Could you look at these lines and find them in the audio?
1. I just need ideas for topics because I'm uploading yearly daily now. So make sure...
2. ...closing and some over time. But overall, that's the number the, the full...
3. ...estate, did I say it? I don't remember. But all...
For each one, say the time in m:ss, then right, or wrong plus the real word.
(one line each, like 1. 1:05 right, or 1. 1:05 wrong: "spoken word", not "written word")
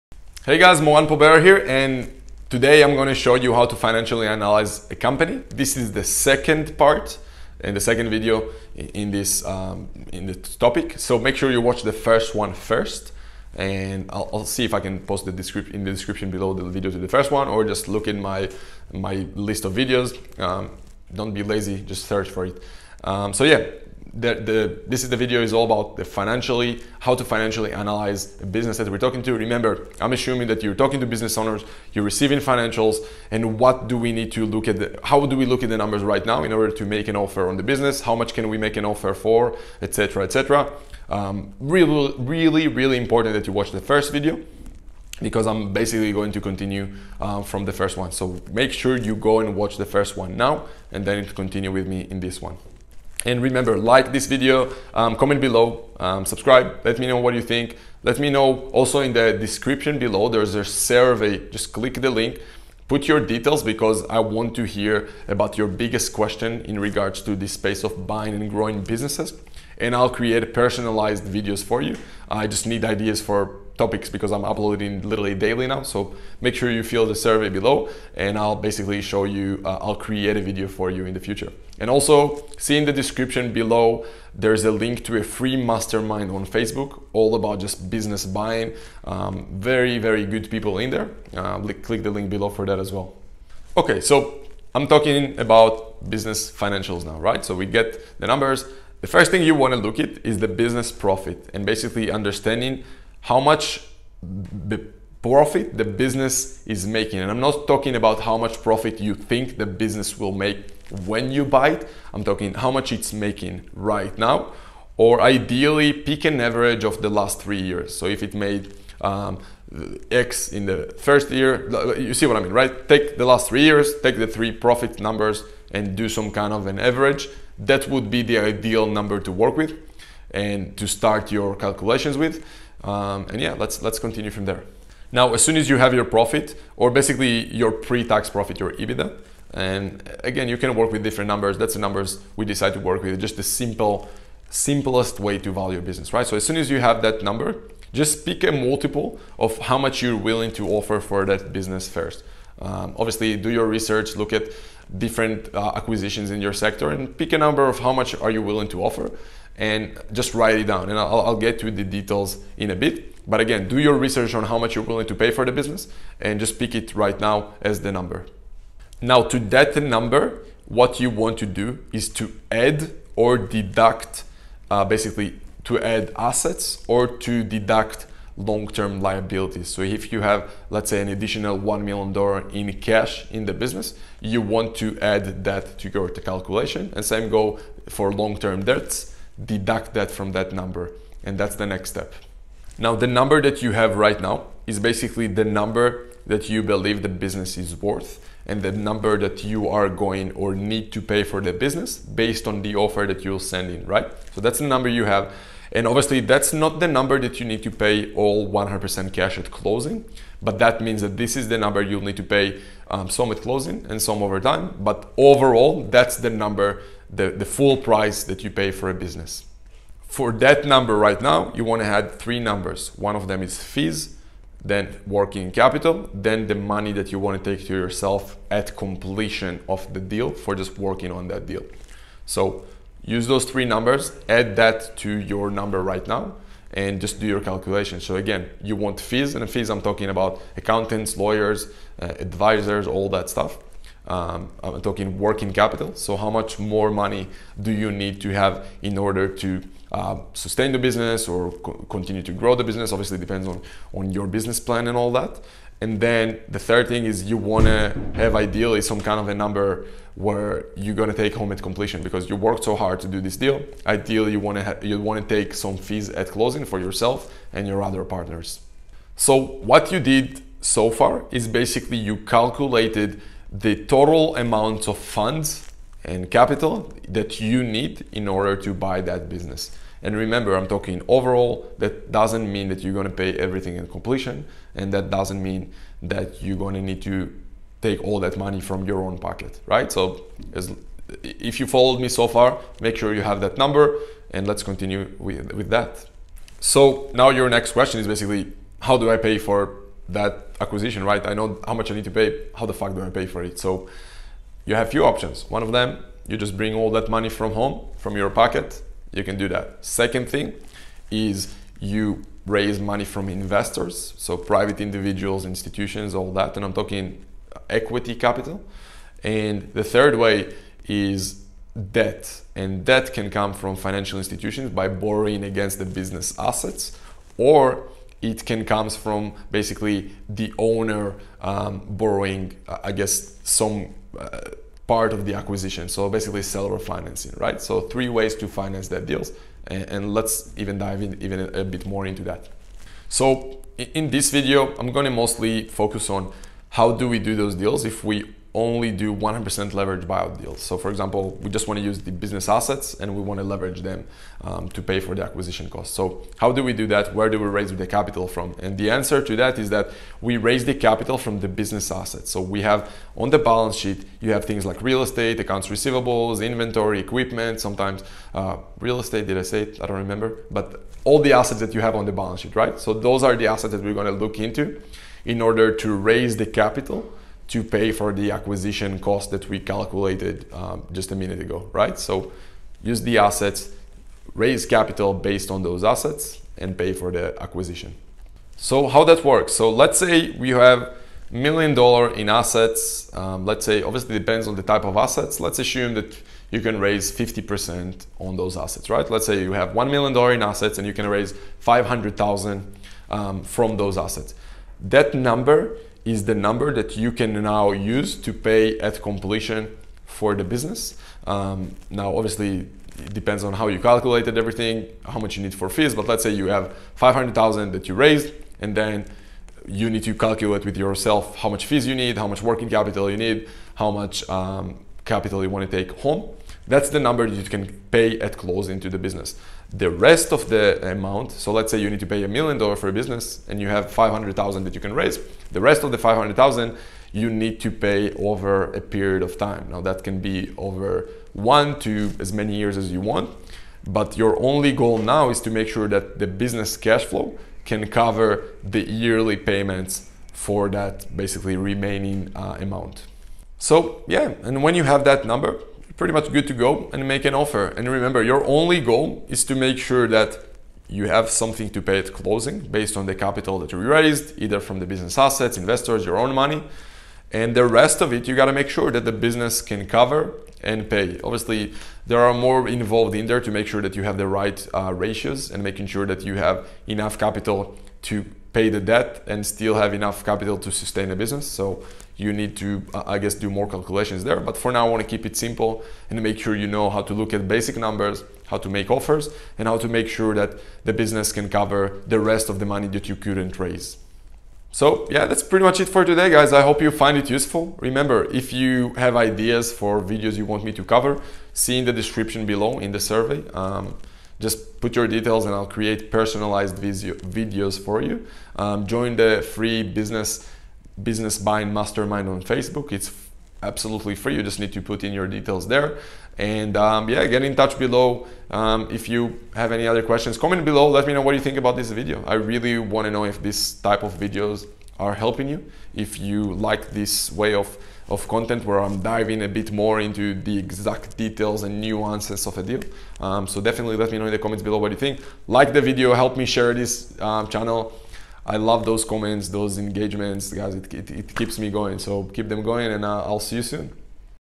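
1. 1:12 wrong: "literally", not "yearly"
2. 3:33 right
3. 6:08 right.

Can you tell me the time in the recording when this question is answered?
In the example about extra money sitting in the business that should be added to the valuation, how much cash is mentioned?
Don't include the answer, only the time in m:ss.
3:01.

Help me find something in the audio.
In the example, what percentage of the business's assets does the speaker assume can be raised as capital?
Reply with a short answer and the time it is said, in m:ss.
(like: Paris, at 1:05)
50%, at 6:37.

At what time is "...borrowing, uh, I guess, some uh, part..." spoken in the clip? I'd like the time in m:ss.
5:31.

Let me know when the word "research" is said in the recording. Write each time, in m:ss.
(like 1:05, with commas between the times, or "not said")
2:33, 2:43.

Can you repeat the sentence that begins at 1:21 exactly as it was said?
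And also see in the description below, there's a link to a free mastermind on Facebook, all about just business buying.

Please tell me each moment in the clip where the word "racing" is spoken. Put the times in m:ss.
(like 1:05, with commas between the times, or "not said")
not said.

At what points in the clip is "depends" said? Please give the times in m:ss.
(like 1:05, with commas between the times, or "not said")
4:13, 6:34, 6:53.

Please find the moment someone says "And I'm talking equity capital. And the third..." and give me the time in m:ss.
5:16.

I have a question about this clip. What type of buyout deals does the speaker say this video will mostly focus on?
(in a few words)
100% leverage buyout.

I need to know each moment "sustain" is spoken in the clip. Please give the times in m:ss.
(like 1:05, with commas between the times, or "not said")
4:10, 8:00.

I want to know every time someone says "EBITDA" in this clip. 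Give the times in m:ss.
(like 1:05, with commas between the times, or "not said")
2:18.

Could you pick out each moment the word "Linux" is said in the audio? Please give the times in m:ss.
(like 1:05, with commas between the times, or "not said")
not said.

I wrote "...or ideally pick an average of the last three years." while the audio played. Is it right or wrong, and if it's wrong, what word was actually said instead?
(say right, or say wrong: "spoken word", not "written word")
right.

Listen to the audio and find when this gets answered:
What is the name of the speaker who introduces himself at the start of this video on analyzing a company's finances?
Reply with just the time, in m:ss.
0:00.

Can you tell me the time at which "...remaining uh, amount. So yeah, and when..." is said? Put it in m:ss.
7:31.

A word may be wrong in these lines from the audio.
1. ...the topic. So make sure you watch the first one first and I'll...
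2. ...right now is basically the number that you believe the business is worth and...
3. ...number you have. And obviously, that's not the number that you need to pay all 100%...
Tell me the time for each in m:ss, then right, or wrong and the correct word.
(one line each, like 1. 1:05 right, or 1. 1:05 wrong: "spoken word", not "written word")
1. 0:10 right
2. 3:13 right
3. 3:24 right.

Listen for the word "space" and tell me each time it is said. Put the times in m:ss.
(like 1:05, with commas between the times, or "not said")
1:07.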